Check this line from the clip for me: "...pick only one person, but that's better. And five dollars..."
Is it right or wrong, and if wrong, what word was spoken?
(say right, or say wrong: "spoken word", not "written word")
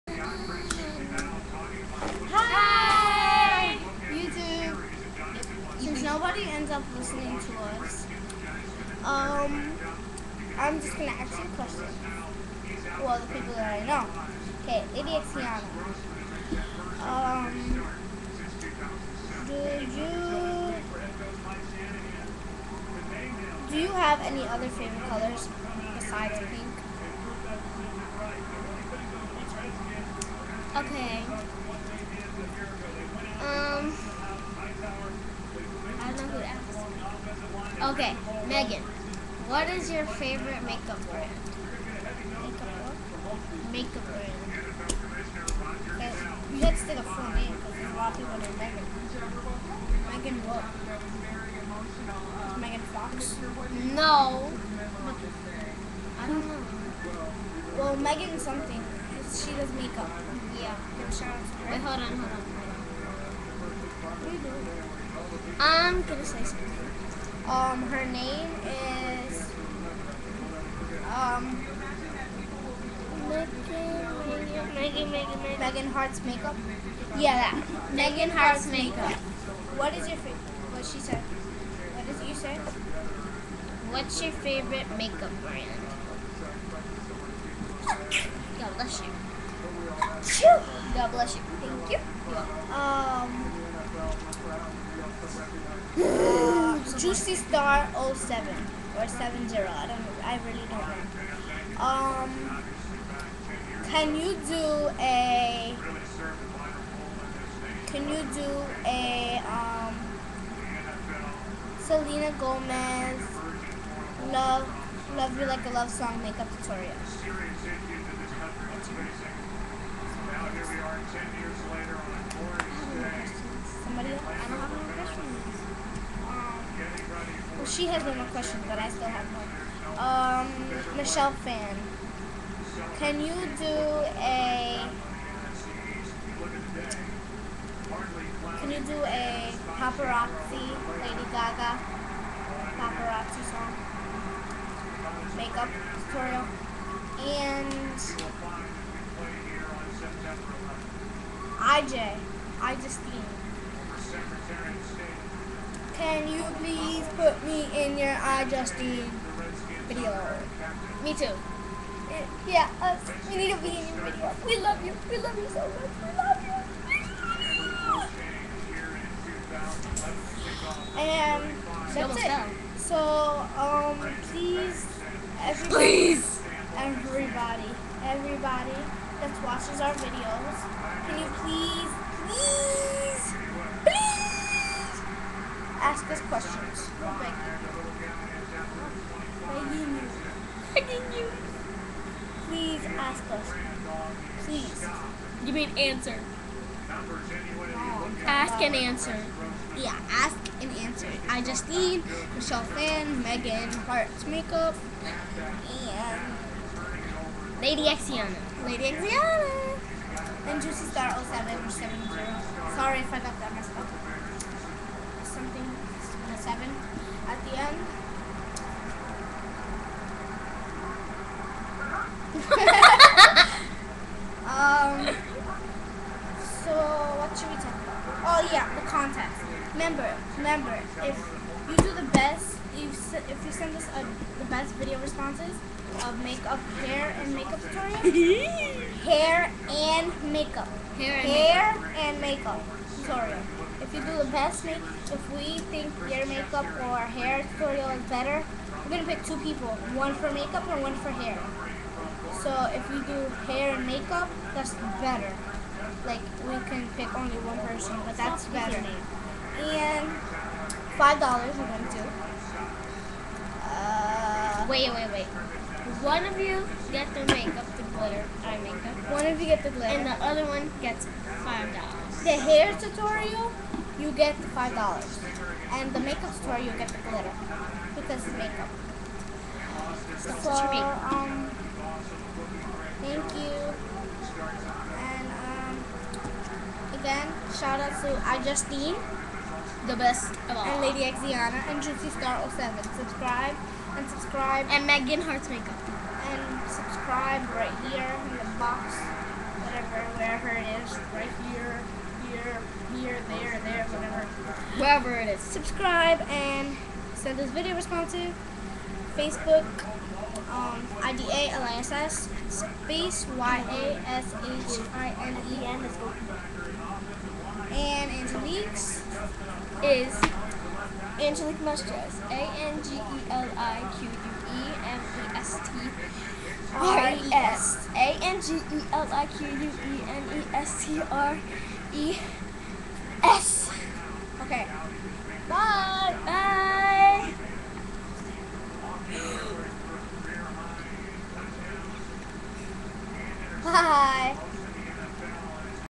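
right.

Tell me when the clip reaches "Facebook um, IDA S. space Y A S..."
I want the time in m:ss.
5:09.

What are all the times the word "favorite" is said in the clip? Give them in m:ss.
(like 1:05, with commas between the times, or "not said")
0:24, 0:40, 1:20, 1:24.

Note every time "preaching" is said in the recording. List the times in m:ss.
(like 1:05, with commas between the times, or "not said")
not said.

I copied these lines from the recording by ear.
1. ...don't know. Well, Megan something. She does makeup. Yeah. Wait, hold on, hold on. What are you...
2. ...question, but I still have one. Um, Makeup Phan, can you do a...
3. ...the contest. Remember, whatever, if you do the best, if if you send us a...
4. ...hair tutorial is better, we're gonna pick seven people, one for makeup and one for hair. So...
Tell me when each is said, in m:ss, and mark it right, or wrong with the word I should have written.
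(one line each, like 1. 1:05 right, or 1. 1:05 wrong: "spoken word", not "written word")
1. 0:56 right
2. 2:08 wrong: "Michelle", not "Makeup"
3. 3:48 wrong: "remember", not "whatever"
4. 4:07 wrong: "two", not "seven".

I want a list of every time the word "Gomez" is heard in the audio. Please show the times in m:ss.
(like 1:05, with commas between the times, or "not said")
1:52.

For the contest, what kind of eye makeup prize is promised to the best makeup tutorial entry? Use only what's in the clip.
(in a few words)
glitter eye makeup.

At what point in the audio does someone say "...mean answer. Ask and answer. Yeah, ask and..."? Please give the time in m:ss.
3:15.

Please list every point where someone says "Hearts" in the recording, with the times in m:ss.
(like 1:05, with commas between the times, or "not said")
1:15, 3:23, 4:55.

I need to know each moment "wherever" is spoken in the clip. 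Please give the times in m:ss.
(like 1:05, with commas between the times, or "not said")
5:00, 5:04.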